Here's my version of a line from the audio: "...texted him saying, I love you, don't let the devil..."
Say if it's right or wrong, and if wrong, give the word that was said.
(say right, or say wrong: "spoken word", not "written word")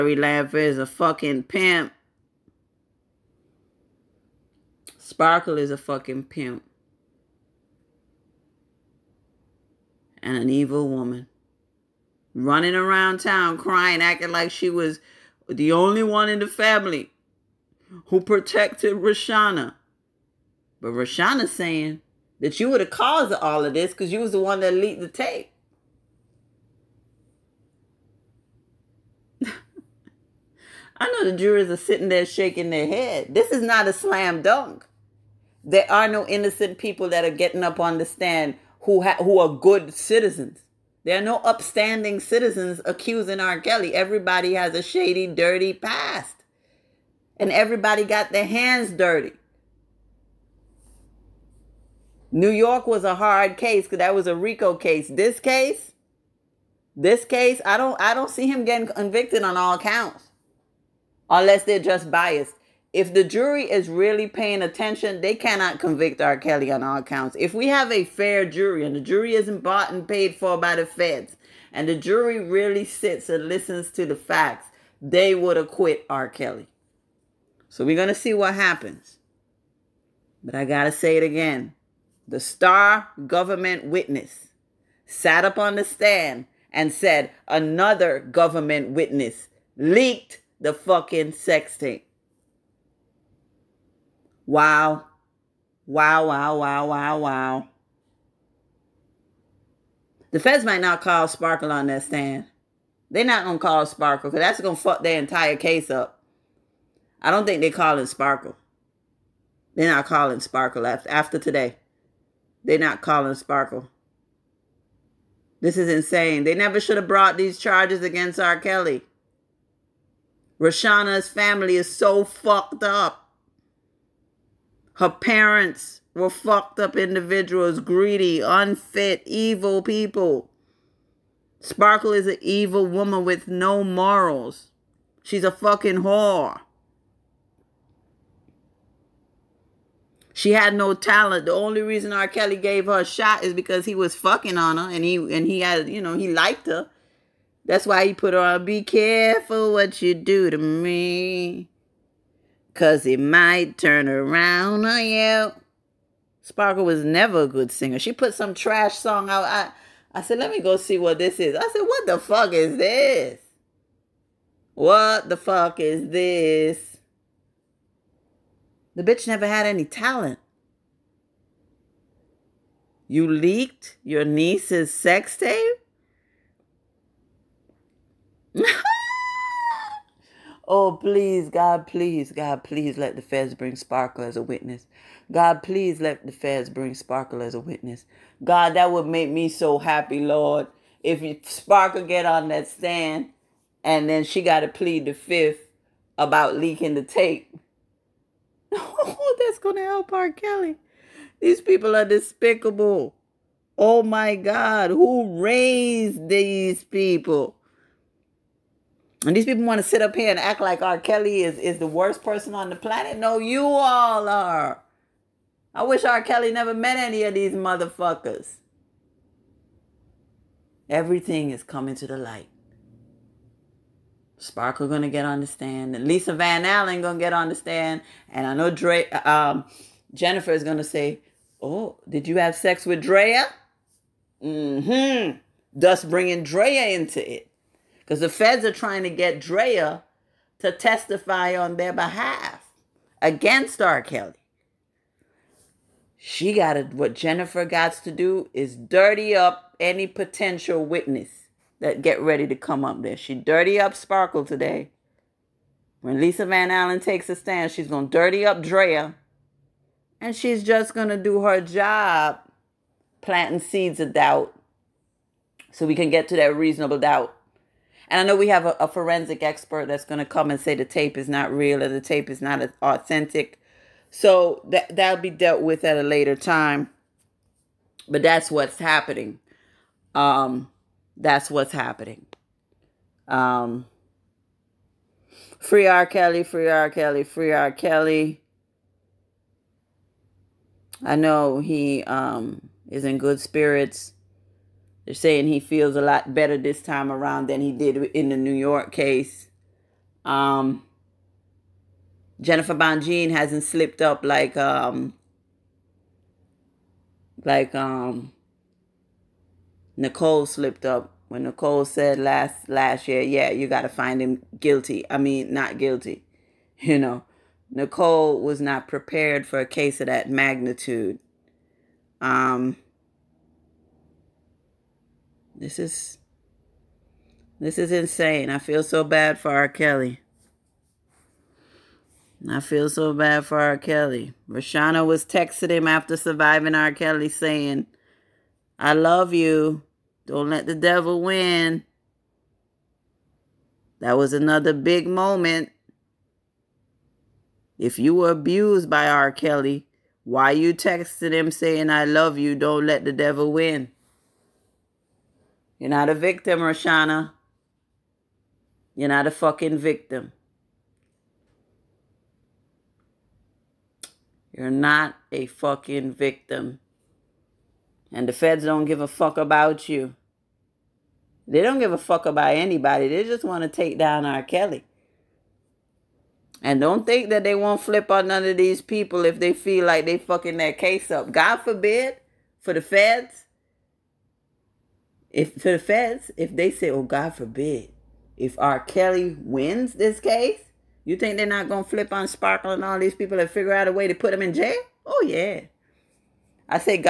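right.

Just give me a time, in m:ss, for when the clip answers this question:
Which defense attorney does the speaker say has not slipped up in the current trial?
5:02.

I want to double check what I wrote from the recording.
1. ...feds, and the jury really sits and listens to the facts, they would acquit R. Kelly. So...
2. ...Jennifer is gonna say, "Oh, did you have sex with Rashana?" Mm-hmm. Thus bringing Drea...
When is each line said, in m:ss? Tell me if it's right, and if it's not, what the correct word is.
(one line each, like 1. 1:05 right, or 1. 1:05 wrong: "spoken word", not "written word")
1. 1:10 right
2. 3:50 wrong: "Drea", not "Rashana".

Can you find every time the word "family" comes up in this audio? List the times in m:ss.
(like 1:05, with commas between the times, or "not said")
0:16, 2:01.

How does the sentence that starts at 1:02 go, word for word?
If the jury is really paying attention, they cannot convict R.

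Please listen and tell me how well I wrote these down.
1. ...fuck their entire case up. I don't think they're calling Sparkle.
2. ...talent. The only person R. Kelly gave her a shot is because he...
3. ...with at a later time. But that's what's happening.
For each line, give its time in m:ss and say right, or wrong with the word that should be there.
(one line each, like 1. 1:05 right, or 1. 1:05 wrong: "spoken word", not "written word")
1. 1:44 right
2. 2:20 wrong: "reason", not "person"
3. 4:35 right.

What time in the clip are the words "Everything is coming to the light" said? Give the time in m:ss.
3:40.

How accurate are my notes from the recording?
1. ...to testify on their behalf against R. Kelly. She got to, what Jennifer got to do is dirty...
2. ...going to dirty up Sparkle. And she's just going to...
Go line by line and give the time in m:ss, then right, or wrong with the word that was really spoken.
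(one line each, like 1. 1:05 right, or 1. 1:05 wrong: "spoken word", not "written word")
1. 4:00 right
2. 4:17 wrong: "Drea", not "Sparkle".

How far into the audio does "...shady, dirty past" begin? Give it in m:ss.
0:44.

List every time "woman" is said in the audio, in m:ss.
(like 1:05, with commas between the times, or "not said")
0:10, 2:12.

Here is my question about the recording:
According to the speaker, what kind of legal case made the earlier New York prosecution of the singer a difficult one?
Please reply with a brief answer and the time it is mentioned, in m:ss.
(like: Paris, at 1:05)
RICO case, at 0:54.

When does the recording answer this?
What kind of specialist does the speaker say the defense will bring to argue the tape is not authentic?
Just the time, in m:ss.
4:28.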